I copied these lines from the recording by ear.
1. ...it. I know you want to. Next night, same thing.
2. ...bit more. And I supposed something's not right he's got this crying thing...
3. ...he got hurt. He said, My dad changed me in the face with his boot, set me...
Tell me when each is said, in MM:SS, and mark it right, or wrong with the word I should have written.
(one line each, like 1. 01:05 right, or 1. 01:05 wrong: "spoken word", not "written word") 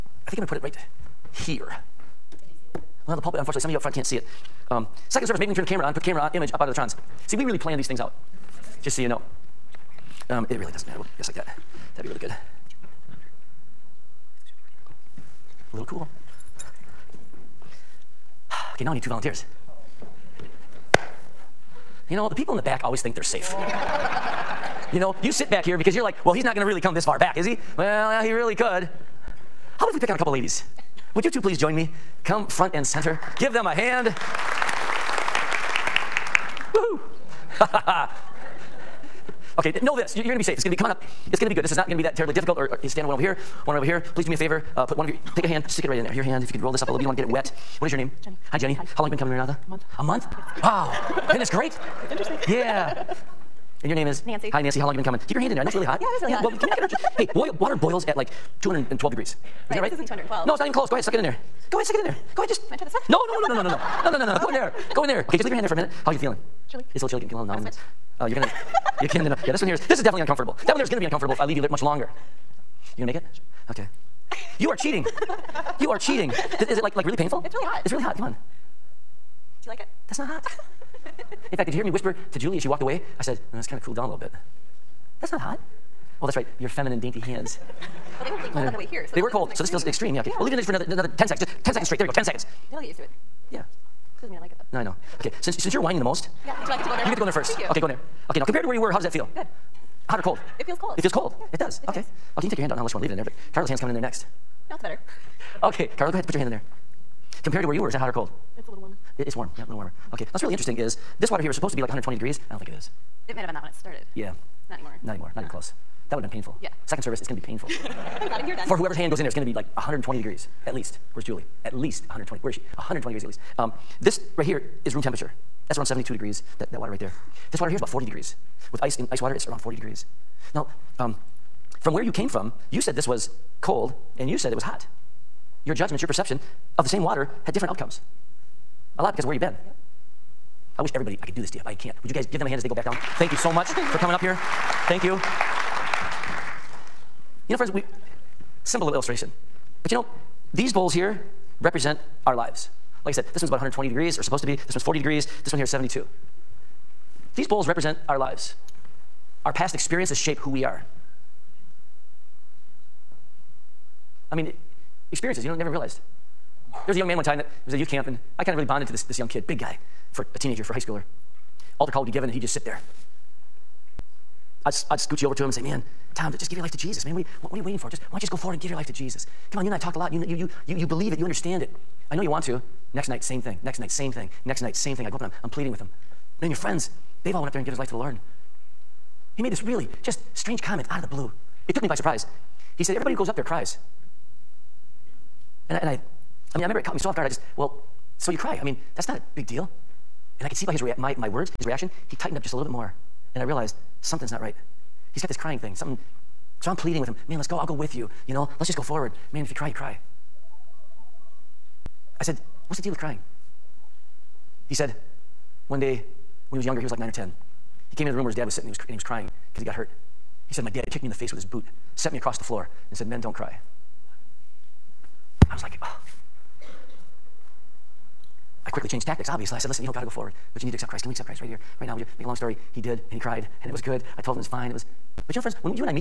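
1. 03:01 right
2. 03:22 wrong: "realized", not "supposed"
3. 03:39 wrong: "kicked", not "changed".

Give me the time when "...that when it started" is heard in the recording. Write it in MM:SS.
01:53.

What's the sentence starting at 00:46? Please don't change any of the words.
Your hand, if you could roll this up a little bit.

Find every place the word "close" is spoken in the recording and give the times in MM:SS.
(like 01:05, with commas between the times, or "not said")
01:00, 01:55.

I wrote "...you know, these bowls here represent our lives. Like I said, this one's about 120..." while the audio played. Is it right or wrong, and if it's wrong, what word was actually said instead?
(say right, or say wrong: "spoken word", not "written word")
right.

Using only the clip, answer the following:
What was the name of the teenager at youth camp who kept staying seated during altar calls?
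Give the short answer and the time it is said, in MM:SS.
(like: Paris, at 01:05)
Tom, at 02:56.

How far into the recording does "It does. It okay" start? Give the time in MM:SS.
01:41.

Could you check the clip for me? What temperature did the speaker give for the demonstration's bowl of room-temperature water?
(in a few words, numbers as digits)
72 degrees.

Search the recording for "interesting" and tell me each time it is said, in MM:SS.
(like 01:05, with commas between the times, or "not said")
00:52, 01:50.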